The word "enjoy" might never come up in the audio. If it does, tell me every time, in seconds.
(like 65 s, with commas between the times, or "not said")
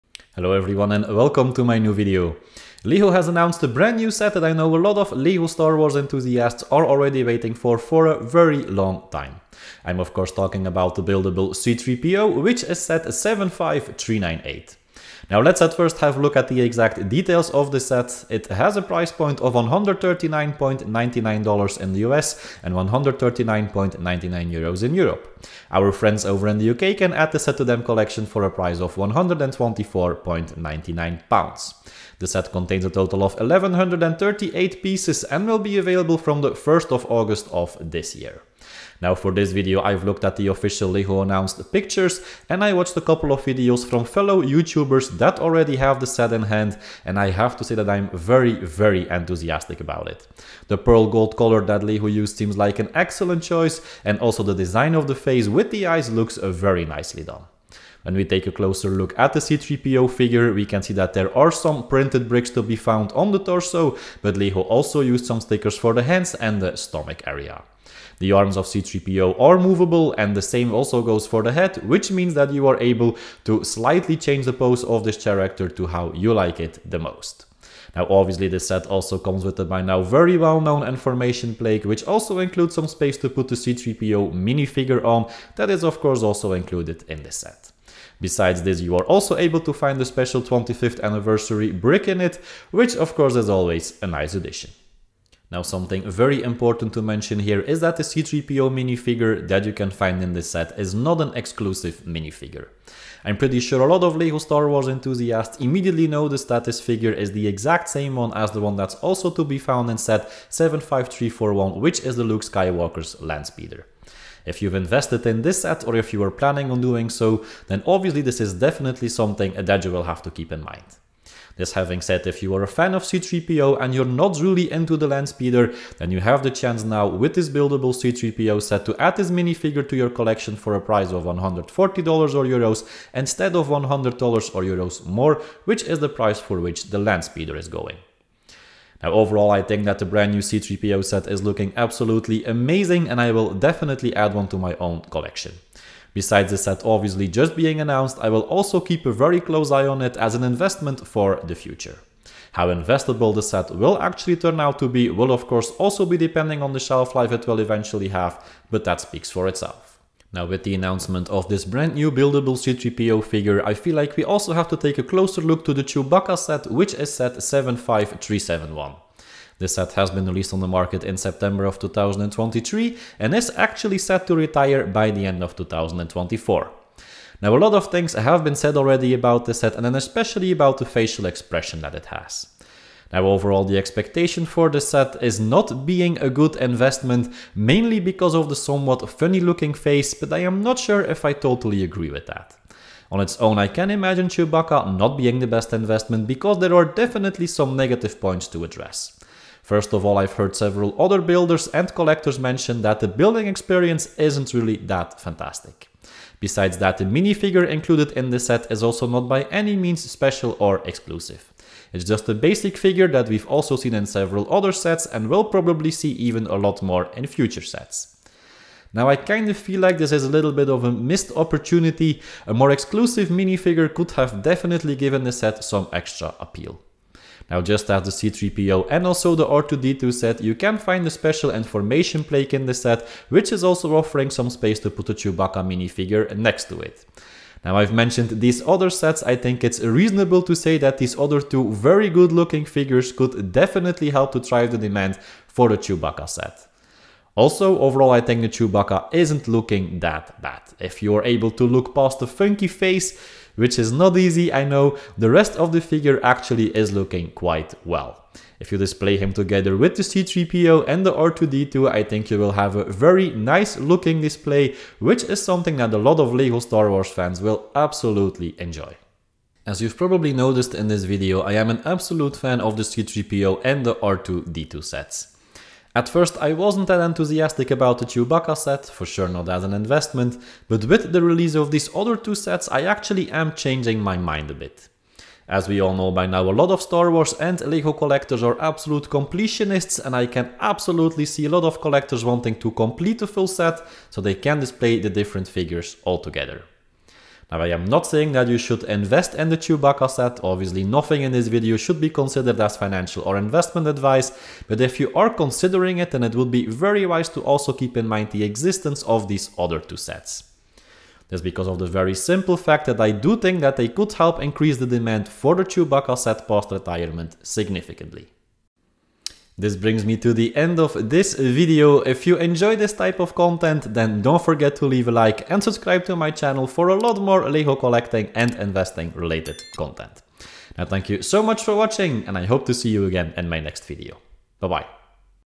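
268 s, 322 s.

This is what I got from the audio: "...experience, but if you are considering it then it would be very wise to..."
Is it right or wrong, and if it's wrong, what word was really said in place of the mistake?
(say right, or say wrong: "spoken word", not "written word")
wrong: "advice", not "experience".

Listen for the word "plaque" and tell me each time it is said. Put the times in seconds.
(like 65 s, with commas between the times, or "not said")
81 s, 232 s.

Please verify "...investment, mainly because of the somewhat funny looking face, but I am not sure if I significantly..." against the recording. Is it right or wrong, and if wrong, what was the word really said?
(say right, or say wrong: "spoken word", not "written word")
wrong: "totally", not "significantly".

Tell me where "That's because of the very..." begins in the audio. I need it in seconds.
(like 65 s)
311 s.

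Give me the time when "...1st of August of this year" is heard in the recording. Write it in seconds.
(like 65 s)
36 s.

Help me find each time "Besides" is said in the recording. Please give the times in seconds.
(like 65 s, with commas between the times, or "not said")
88 s, 146 s, 206 s.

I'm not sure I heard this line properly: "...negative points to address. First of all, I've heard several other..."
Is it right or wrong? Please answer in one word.
right.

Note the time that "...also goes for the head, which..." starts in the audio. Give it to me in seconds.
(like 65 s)
70 s.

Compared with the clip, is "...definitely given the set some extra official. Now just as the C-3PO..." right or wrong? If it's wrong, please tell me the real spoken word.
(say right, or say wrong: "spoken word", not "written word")
wrong: "appeal", not "official".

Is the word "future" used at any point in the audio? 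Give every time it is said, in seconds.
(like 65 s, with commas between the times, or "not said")
151 s, 217 s.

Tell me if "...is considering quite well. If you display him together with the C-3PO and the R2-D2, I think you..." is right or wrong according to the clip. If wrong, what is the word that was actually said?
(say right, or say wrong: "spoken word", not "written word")
wrong: "looking", not "considering".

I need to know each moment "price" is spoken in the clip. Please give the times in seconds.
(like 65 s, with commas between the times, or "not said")
18 s, 28 s, 130 s, 136 s.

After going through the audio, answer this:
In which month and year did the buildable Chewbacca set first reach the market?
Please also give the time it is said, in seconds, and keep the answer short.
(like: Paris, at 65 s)
September 2023, at 171 s.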